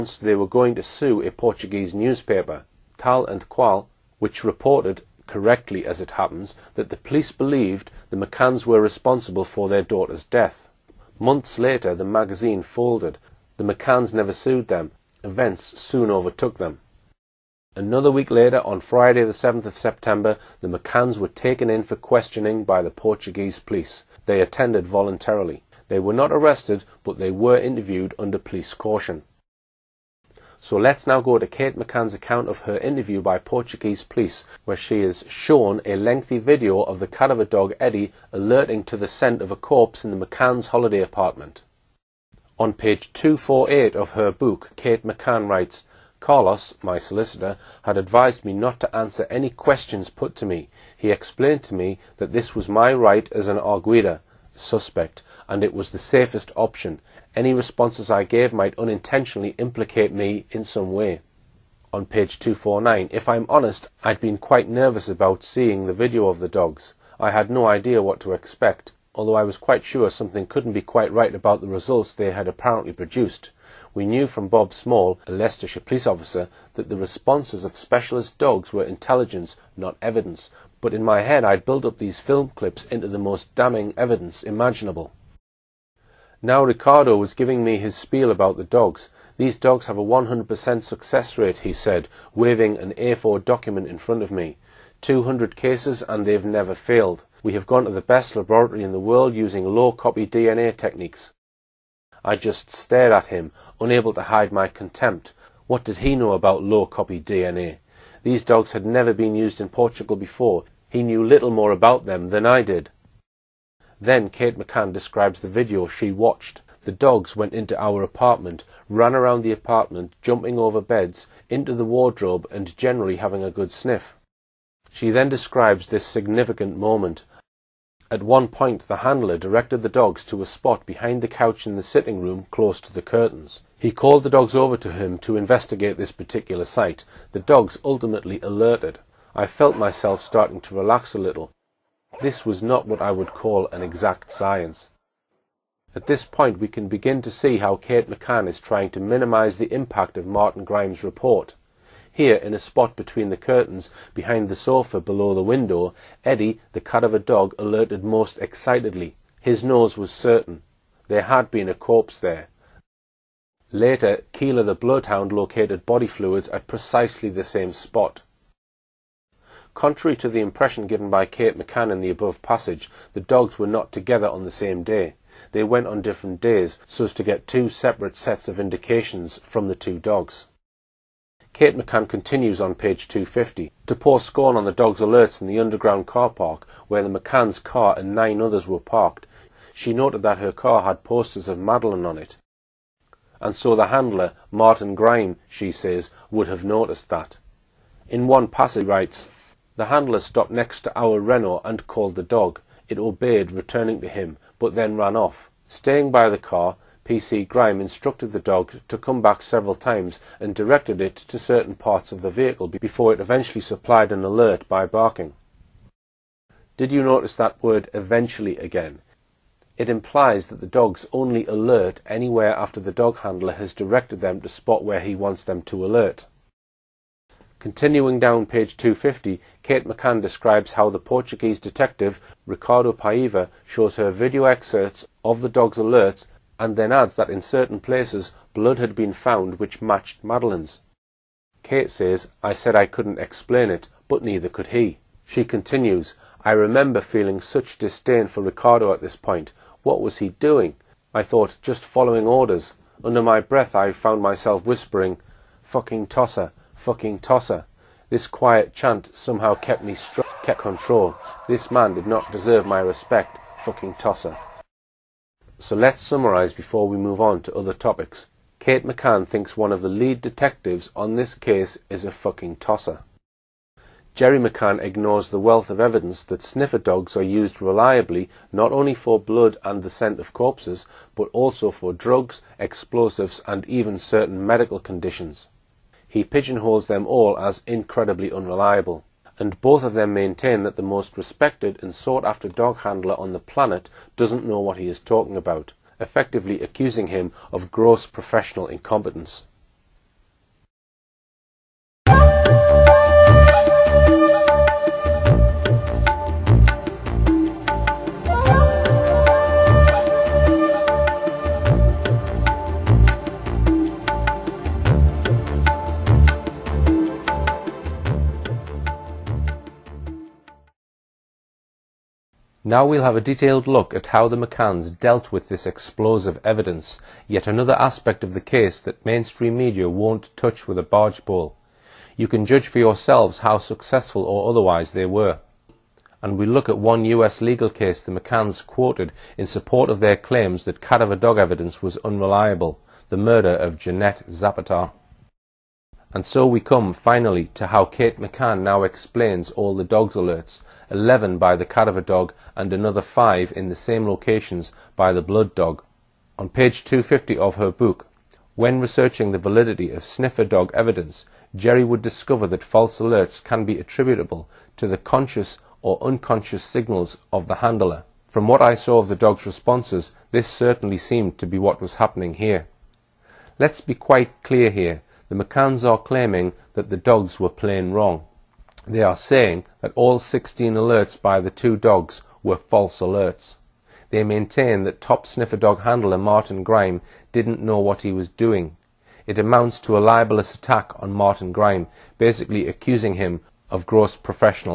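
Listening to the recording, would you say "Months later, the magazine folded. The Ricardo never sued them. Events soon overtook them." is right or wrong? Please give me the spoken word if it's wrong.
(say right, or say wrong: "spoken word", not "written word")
wrong: "McCanns", not "Ricardo".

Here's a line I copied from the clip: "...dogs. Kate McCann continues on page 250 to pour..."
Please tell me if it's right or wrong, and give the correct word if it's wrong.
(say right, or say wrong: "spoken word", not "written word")
right.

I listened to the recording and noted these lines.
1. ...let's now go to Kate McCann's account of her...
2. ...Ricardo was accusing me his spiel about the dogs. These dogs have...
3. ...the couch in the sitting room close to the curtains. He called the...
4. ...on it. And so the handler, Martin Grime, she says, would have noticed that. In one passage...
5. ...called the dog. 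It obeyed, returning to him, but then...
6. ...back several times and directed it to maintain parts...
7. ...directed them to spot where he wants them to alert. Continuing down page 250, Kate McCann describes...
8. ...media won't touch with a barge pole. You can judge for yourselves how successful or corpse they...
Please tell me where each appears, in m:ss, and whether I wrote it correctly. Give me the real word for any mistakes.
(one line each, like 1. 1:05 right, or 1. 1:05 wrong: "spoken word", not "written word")
1. 0:30 right
2. 1:26 wrong: "giving", not "accusing"
3. 2:11 right
4. 3:12 right
5. 3:21 right
6. 3:29 wrong: "certain", not "maintain"
7. 3:43 right
8. 5:29 wrong: "otherwise", not "corpse".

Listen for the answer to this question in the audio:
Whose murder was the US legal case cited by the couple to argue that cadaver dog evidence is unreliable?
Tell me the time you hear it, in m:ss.
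5:43.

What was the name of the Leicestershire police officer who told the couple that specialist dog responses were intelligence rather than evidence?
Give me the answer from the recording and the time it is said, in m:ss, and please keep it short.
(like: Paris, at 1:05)
Bob Small, at 1:14.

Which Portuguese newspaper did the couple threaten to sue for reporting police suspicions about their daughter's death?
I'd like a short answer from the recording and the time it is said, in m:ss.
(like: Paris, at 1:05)
Tal and Qual, at 0:02.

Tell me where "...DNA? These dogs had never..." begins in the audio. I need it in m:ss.
1:47.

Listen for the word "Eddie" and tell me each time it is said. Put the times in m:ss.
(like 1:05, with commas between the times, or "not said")
0:37, 2:36.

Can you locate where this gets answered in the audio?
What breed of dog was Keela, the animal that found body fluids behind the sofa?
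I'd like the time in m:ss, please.
2:44.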